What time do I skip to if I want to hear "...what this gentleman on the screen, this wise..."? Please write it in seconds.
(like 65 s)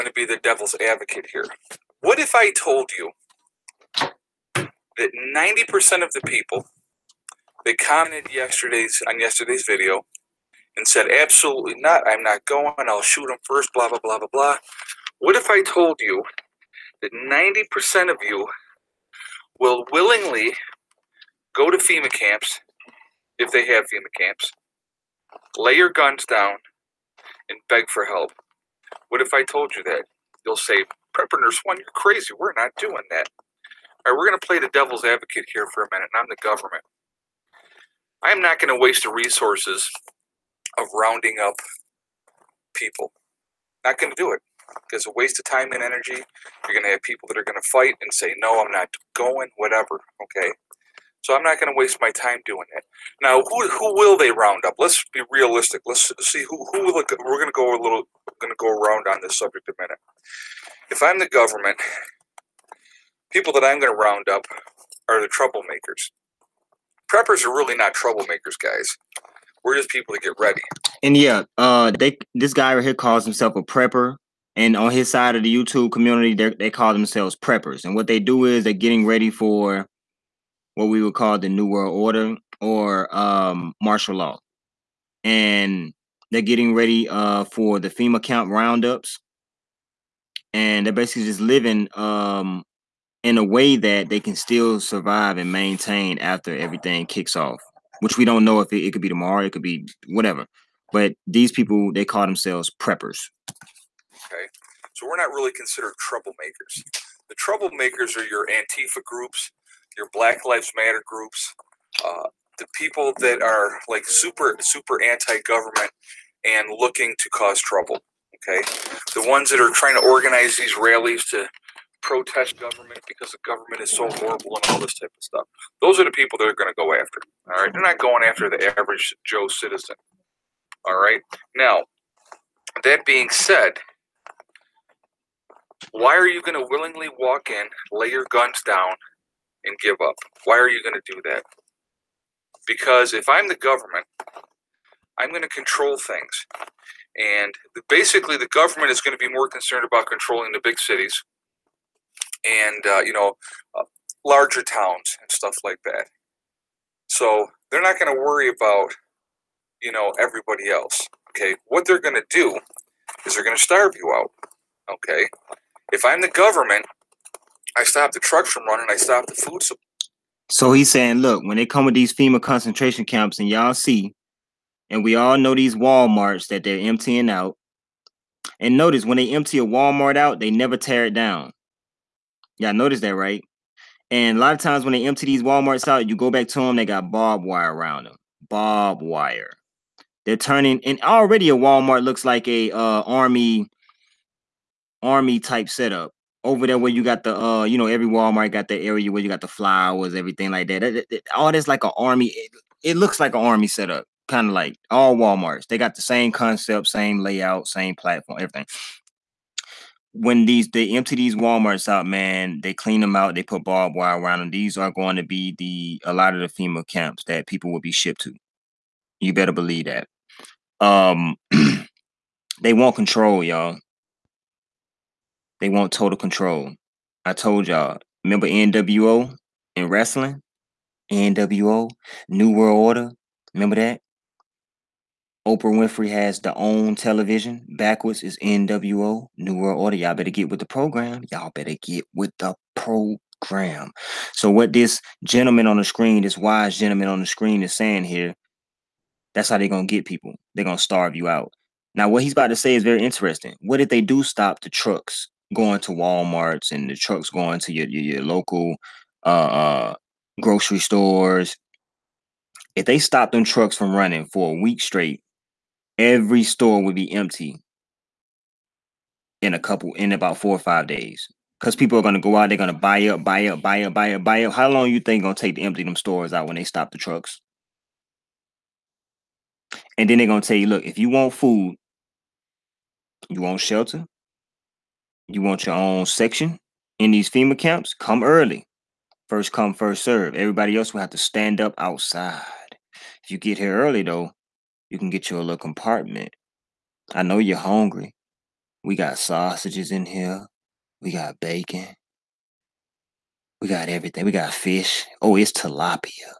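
244 s.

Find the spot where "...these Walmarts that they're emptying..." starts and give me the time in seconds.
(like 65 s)
175 s.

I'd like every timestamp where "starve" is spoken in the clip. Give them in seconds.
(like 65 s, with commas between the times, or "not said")
163 s, 250 s.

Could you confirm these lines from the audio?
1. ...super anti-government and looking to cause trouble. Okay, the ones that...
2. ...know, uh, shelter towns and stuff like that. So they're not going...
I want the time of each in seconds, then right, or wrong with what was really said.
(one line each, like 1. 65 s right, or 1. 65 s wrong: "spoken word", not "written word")
1. 114 s right
2. 153 s wrong: "larger", not "shelter".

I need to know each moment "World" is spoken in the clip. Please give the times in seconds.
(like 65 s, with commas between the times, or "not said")
81 s, 232 s, 239 s.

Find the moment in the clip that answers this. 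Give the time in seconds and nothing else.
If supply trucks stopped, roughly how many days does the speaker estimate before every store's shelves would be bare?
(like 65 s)
270 s.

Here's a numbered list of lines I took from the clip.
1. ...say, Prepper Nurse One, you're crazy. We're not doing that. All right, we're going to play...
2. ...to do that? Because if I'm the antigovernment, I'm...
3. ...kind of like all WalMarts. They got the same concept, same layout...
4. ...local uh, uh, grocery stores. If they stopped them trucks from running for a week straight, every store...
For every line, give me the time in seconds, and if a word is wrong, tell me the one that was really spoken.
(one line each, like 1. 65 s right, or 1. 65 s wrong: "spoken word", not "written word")
1. 30 s right
2. 140 s wrong: "government", not "antigovernment"
3. 204 s right
4. 258 s right.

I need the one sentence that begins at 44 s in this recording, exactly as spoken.
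It's a waste of time and energy.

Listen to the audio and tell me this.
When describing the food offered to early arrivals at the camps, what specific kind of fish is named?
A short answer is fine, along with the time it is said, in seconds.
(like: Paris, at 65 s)
Tilapia, at 305 s.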